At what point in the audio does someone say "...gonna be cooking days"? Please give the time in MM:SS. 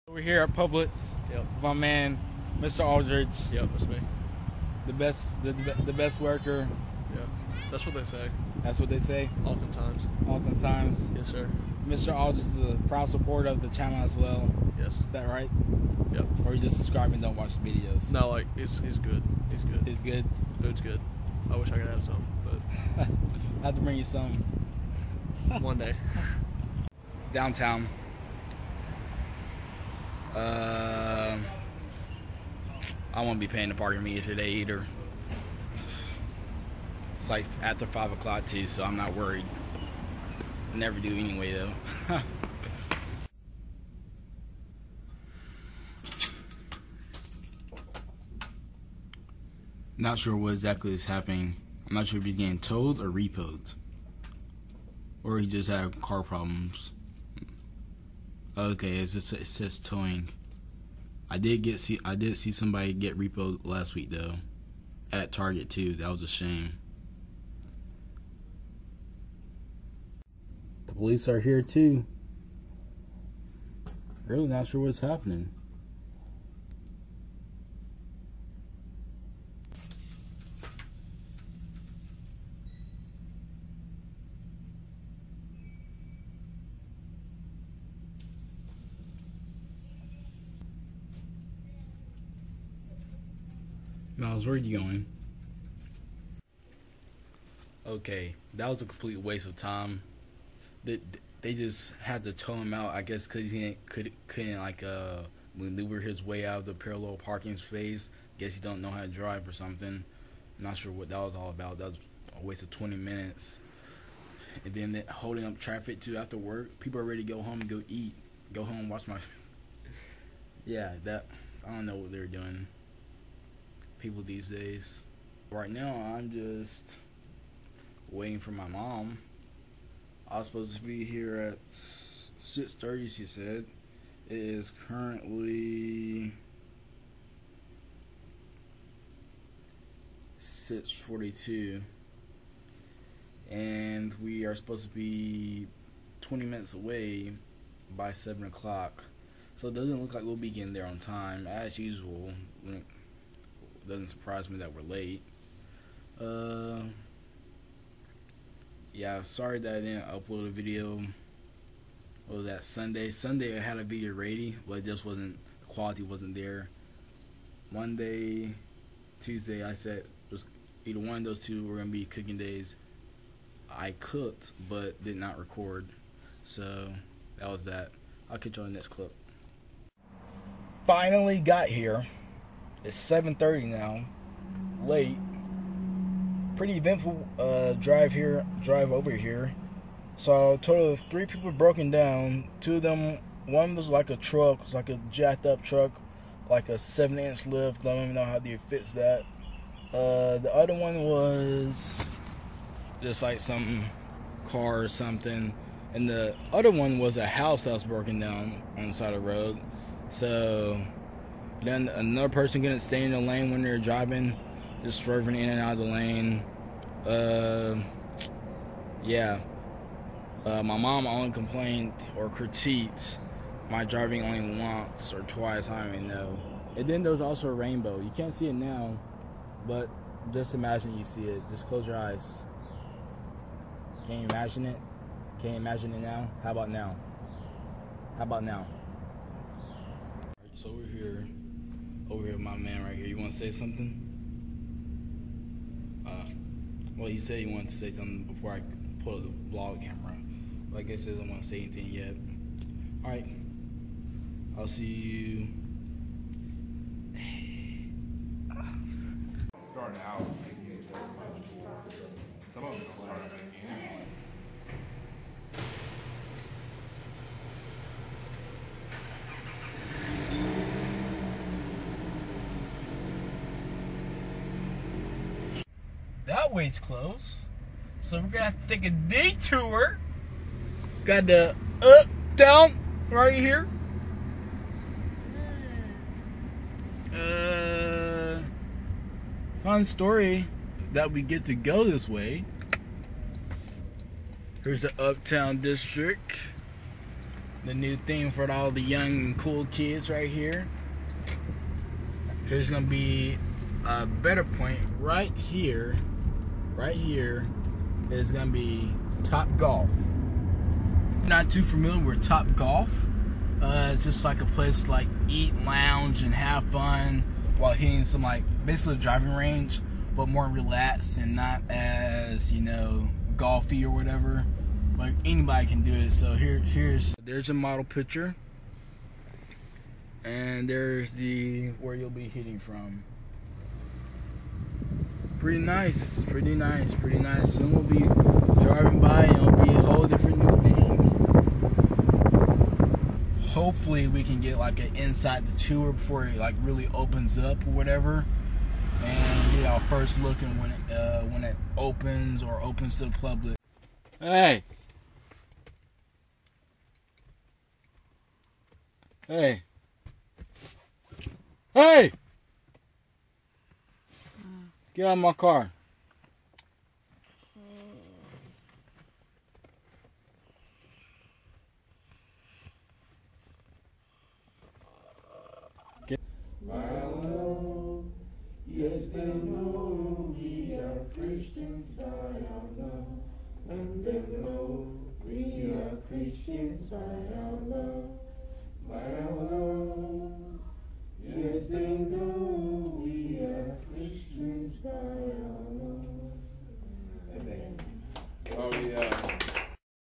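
02:51.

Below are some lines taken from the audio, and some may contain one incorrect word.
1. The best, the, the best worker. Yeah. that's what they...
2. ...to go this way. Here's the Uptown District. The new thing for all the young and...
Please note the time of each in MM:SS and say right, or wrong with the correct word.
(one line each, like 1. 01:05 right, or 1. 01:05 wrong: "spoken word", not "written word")
1. 00:04 right
2. 04:51 right.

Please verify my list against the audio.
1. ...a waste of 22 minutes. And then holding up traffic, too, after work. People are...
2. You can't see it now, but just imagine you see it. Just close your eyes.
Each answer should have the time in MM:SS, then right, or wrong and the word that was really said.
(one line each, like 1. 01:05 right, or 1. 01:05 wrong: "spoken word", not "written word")
1. 01:52 wrong: "20", not "22"
2. 03:48 right.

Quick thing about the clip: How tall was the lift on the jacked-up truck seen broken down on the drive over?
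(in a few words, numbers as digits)
7 inches.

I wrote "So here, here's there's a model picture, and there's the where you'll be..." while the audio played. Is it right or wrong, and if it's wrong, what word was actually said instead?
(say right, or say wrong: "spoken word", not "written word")
right.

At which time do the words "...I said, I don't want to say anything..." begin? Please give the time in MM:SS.
04:10.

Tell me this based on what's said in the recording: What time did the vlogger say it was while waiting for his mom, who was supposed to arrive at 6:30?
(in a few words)
6:42.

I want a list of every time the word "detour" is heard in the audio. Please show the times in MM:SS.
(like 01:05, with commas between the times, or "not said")
04:38.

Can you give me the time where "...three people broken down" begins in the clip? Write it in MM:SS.
03:11.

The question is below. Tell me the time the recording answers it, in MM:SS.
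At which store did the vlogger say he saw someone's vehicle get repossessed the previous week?
01:05.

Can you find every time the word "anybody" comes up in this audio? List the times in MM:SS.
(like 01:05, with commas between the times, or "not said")
05:25.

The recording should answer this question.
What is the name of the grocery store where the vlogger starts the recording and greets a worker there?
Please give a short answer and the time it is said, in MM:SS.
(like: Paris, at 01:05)
Publix, at 00:00.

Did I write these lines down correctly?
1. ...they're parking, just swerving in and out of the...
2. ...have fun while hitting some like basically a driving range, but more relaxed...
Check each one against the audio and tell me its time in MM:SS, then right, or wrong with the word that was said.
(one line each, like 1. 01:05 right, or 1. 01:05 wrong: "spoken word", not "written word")
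1. 03:33 wrong: "driving", not "parking"
2. 05:16 right.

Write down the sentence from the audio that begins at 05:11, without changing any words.
Not too familiar with Top Golf.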